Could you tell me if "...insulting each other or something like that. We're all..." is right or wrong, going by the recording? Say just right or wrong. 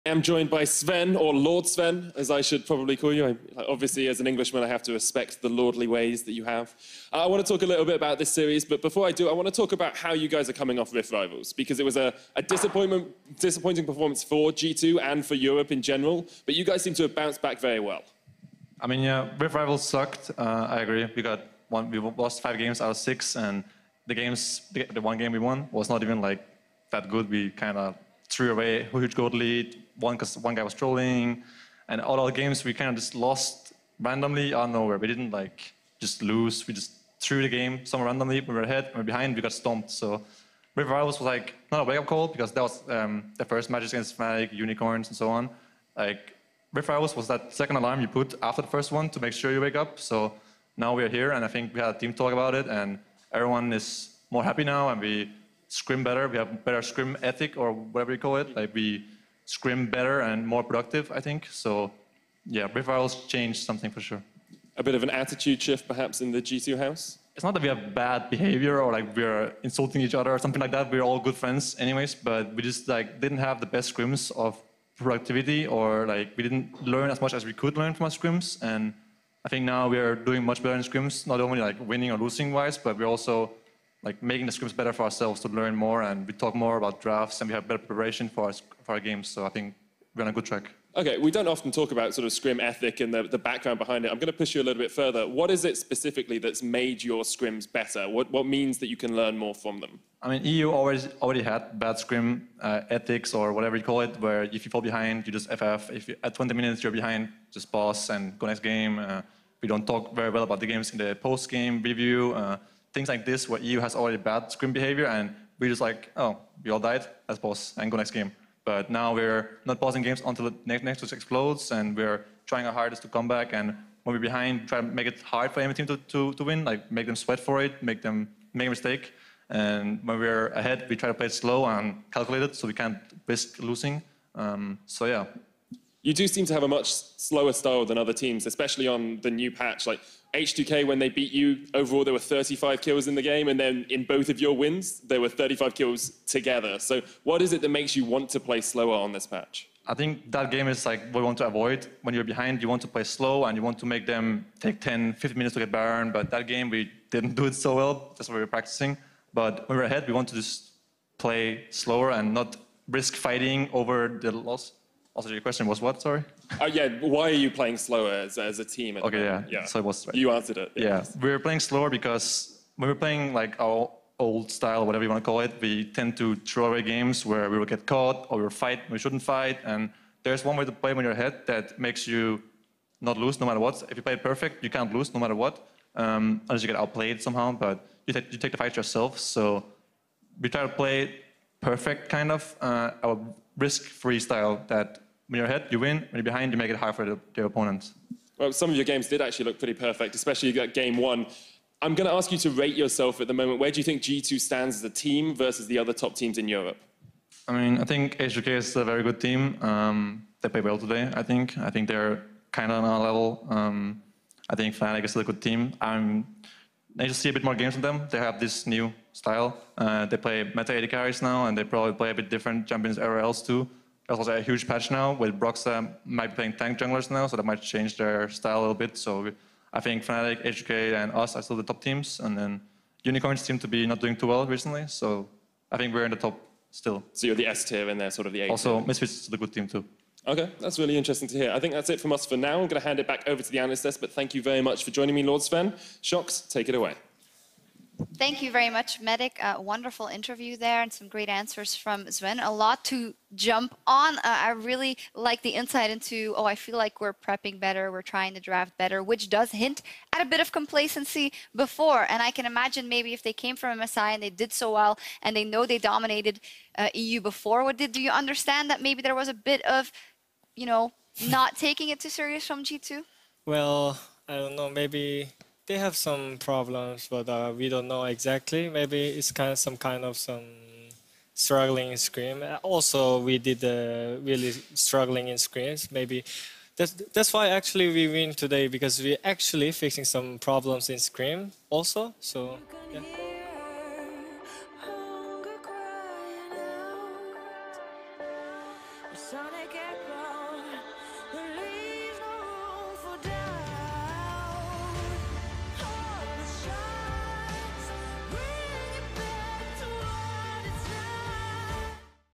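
right.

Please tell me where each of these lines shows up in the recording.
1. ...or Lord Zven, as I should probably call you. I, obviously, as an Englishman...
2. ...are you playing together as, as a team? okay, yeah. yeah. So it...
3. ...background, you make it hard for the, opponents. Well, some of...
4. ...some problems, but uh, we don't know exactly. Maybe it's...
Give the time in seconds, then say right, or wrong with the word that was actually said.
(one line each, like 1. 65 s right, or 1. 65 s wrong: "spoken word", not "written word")
1. 1 s right
2. 167 s wrong: "slower", not "together"
3. 196 s wrong: "behind", not "background"
4. 275 s right.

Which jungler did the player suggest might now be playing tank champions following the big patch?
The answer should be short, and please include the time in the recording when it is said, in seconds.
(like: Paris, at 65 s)
Broxah, at 225 s.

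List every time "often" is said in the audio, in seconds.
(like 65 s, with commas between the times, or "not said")
91 s.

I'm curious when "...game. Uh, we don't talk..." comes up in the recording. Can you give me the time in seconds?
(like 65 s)
108 s.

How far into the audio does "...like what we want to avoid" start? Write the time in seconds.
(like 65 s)
150 s.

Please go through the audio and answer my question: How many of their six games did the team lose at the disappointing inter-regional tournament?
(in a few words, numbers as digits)
5.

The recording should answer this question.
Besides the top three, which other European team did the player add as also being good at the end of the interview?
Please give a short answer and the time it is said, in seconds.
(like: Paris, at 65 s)
Misfits, at 238 s.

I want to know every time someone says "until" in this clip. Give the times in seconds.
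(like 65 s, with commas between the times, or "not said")
120 s.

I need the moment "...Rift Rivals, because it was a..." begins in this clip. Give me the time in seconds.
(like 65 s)
10 s.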